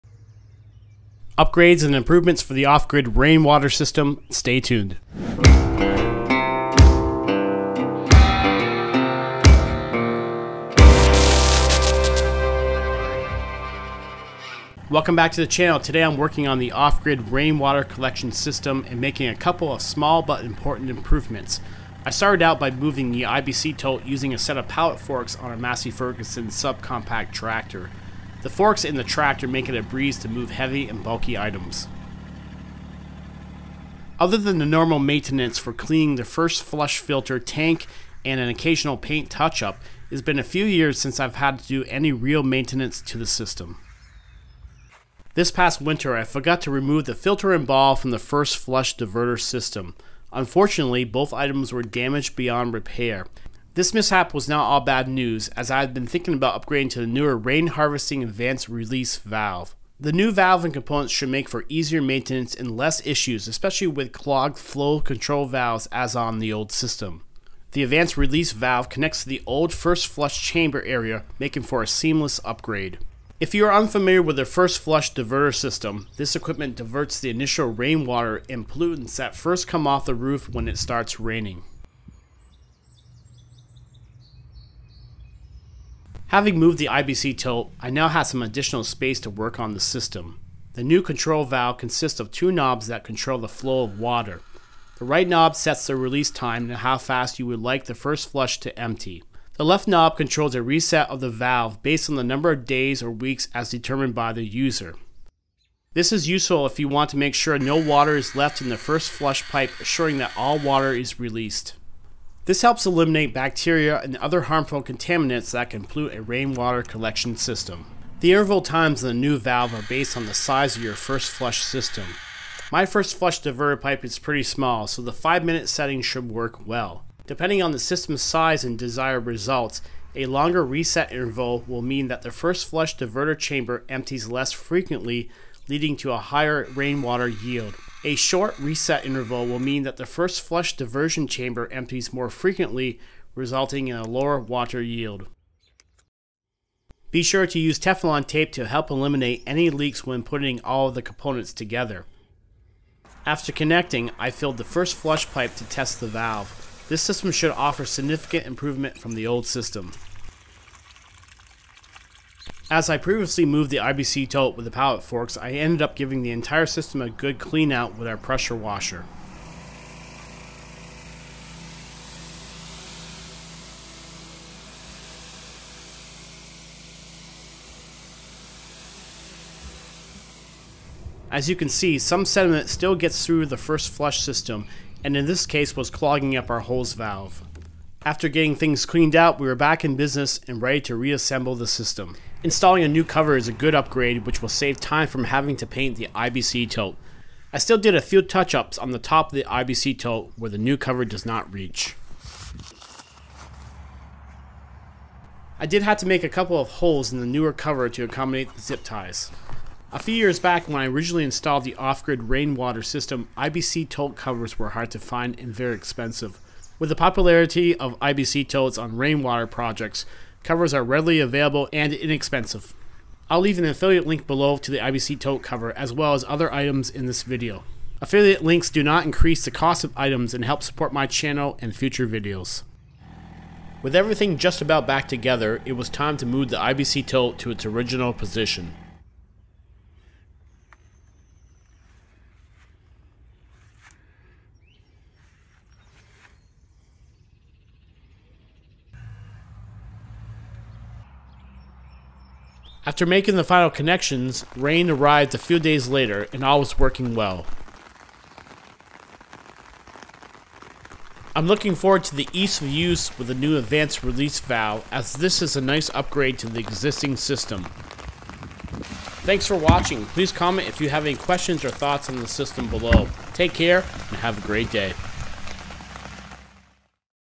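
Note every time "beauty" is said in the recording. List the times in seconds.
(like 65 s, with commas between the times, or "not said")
not said.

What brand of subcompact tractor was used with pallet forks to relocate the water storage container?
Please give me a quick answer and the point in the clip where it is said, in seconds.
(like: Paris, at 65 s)
Massey Ferguson, at 25 s.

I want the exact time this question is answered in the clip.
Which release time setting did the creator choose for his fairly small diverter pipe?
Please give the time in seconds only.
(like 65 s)
125 s.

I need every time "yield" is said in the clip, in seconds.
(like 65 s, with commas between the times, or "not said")
137 s, 144 s.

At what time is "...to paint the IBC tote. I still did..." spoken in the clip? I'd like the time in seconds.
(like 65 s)
195 s.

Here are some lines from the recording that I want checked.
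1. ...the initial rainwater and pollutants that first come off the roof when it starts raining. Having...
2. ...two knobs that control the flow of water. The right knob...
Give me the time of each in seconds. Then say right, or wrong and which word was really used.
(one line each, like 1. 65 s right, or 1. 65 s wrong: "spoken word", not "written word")
1. 77 s right
2. 92 s right.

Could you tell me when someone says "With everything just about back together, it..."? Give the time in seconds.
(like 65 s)
233 s.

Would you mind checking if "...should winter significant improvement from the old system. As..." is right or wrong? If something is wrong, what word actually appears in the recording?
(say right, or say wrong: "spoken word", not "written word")
wrong: "offer", not "winter".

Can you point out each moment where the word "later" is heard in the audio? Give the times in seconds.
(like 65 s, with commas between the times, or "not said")
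255 s.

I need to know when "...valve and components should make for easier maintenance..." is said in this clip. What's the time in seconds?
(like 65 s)
60 s.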